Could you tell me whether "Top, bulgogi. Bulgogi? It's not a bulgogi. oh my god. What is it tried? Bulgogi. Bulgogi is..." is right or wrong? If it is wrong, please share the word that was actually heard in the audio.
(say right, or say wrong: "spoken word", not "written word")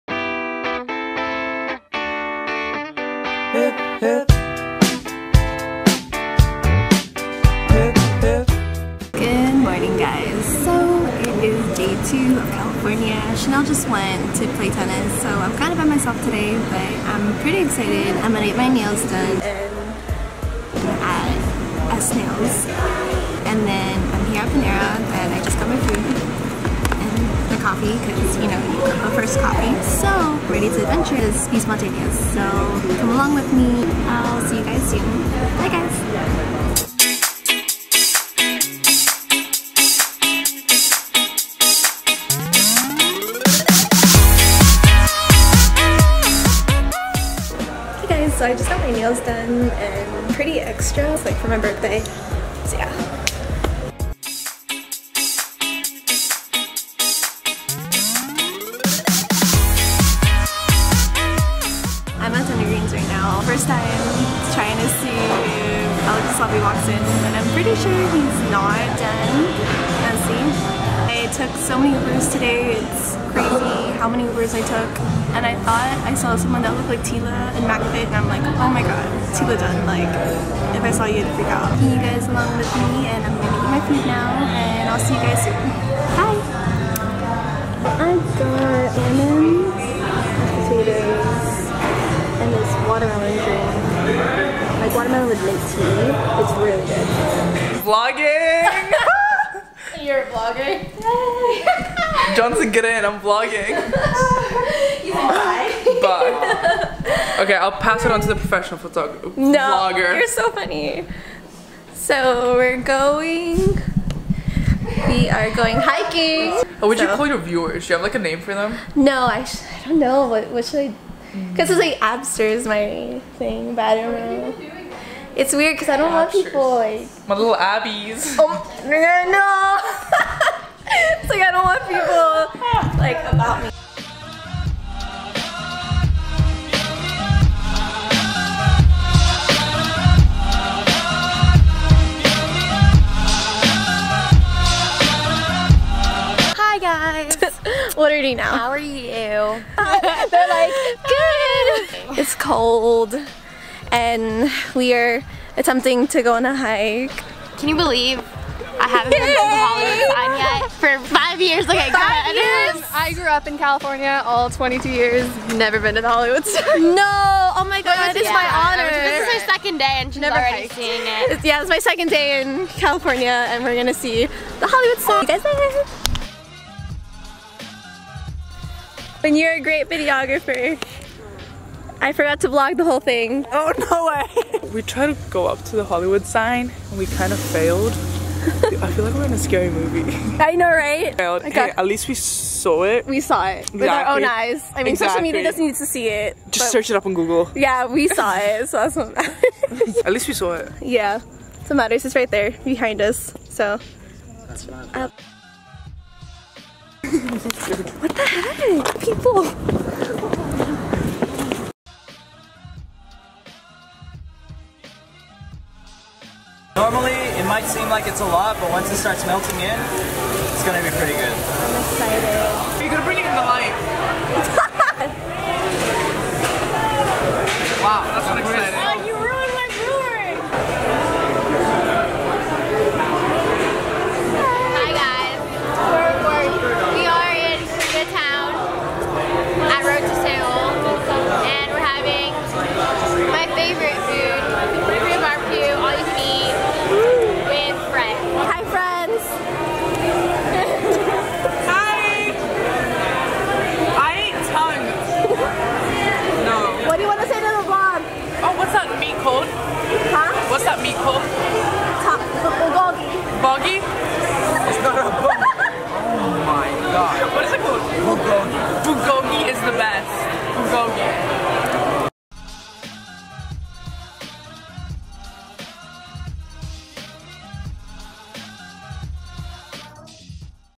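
wrong: "called", not "tried".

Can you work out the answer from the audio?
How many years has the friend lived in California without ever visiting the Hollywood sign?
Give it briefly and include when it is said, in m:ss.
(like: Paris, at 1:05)
22, at 2:44.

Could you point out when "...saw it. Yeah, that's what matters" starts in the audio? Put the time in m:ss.
3:20.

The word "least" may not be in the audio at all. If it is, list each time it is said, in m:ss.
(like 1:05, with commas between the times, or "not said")
3:11, 3:20.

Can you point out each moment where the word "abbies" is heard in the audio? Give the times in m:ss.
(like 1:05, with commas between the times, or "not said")
2:07.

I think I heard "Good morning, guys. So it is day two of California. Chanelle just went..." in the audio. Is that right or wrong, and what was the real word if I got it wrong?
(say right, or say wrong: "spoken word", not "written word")
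right.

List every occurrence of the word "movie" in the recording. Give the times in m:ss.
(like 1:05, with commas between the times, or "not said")
3:09.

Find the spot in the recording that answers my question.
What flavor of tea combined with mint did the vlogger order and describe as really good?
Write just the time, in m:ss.
1:35.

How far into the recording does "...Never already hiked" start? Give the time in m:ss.
2:50.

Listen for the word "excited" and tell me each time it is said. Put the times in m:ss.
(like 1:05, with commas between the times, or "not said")
0:17, 3:41, 3:48.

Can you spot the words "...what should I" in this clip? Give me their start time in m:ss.
2:00.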